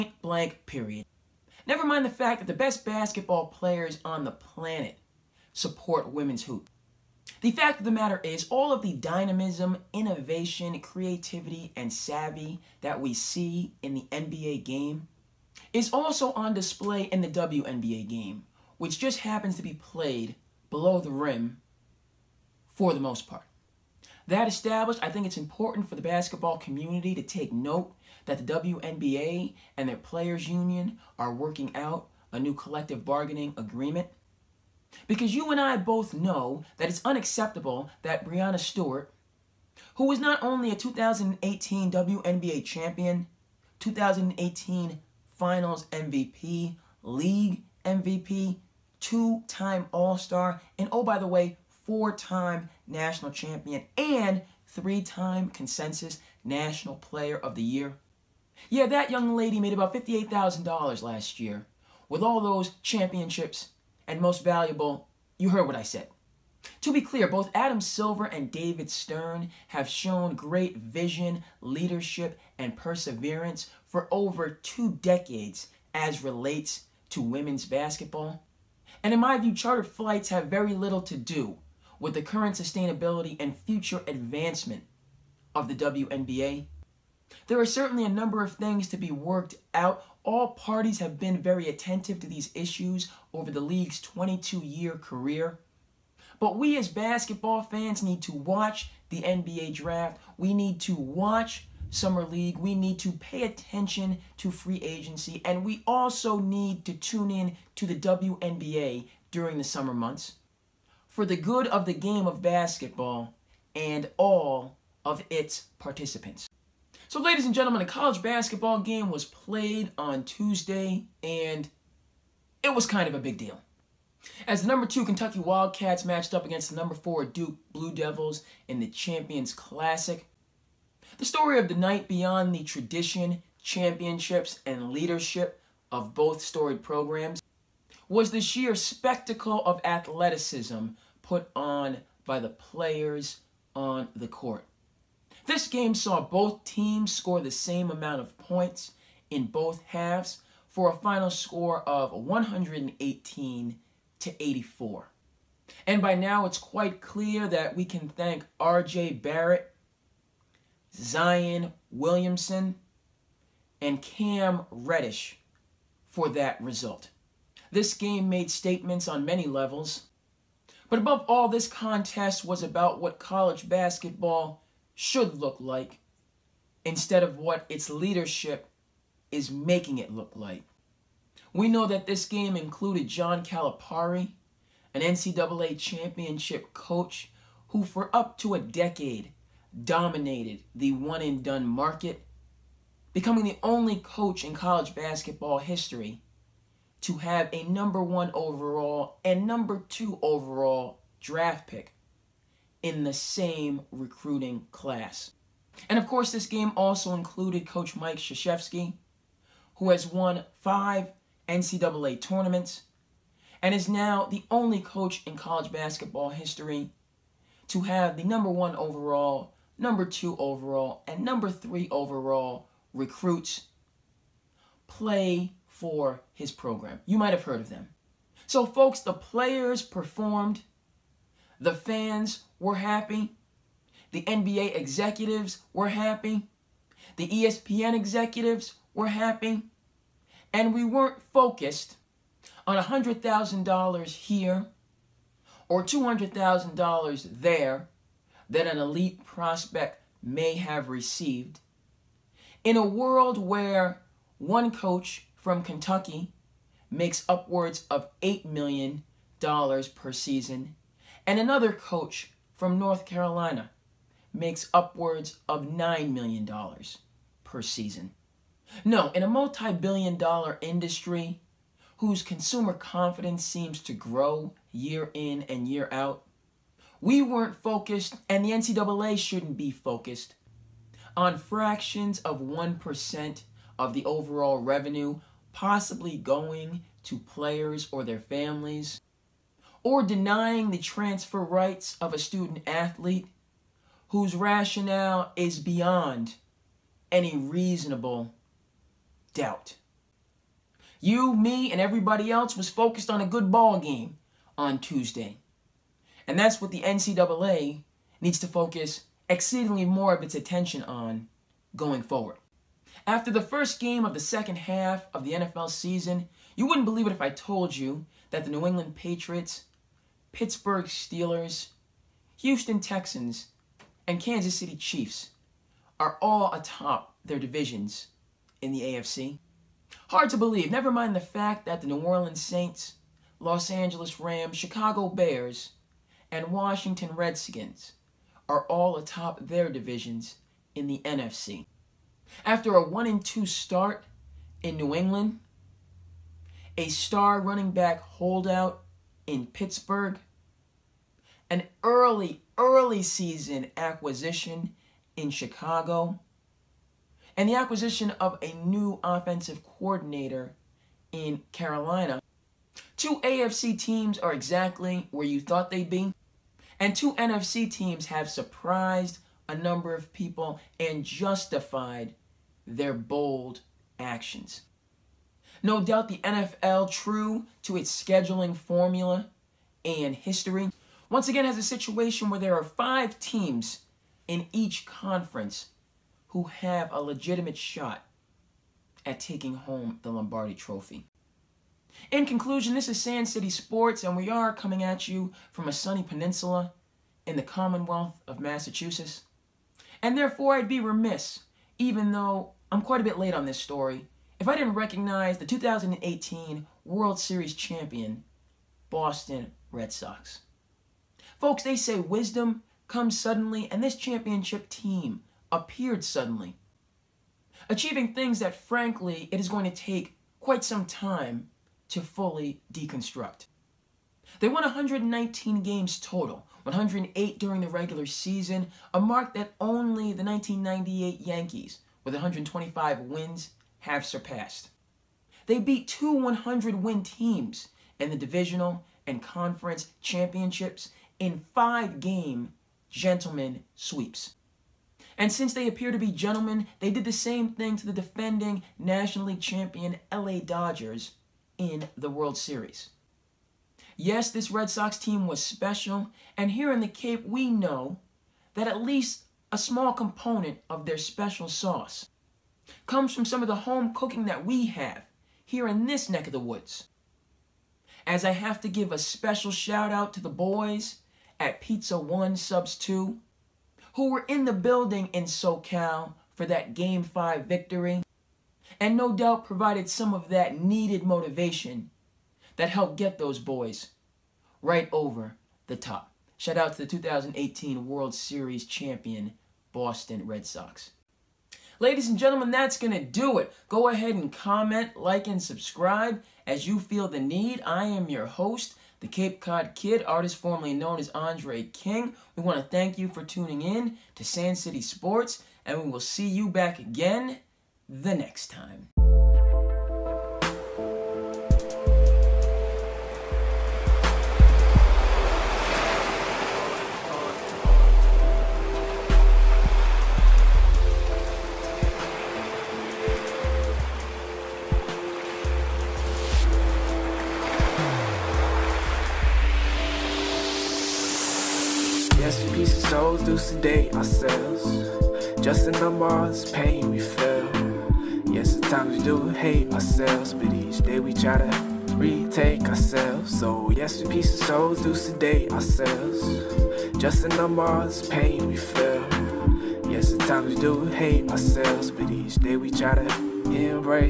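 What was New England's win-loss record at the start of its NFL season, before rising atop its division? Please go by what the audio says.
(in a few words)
1 and 2.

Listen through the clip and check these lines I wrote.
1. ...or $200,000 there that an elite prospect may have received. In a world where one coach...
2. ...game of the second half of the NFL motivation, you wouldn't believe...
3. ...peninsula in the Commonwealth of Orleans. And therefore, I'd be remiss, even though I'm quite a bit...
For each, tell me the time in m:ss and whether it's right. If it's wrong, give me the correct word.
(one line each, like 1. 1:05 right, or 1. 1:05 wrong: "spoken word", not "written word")
1. 4:05 right
2. 5:13 wrong: "season", not "motivation"
3. 6:36 wrong: "Massachusetts", not "Orleans".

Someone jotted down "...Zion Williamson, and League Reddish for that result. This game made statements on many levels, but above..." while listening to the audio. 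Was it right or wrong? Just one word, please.
wrong.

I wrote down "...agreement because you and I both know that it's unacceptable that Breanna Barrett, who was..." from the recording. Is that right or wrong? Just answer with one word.
wrong.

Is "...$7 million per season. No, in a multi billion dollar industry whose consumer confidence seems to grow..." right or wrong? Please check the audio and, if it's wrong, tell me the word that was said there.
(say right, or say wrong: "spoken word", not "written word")
wrong: "9", not "7".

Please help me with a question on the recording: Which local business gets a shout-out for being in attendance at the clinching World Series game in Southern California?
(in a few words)
Pizza One Subs 2.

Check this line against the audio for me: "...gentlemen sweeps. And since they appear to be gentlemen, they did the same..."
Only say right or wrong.
right.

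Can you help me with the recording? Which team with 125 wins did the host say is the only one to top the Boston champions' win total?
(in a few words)
1998 Yankees.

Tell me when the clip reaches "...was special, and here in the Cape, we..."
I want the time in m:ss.
7:35.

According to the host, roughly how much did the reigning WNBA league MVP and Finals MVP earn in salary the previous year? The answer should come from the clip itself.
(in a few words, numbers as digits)
$58,000.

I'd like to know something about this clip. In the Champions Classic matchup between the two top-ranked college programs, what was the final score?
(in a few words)
118 to 84.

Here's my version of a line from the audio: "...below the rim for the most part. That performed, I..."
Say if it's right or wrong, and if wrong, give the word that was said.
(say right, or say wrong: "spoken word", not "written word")
wrong: "established", not "performed".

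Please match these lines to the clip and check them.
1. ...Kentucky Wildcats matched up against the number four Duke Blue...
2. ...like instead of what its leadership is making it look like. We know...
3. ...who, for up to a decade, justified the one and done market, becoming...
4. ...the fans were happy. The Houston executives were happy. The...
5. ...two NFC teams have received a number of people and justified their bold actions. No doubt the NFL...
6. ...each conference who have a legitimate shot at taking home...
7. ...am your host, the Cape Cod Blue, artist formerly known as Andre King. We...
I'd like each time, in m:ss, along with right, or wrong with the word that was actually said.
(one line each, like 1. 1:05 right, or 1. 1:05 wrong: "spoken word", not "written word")
1. 2:05 right
2. 2:55 right
3. 3:07 wrong: "dominated", not "justified"
4. 3:51 wrong: "NBA", not "Houston"
5. 6:06 wrong: "surprised", not "received"
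6. 6:24 right
7. 8:17 wrong: "Kid", not "Blue".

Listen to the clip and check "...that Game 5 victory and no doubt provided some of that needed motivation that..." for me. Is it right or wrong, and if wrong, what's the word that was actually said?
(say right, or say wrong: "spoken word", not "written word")
right.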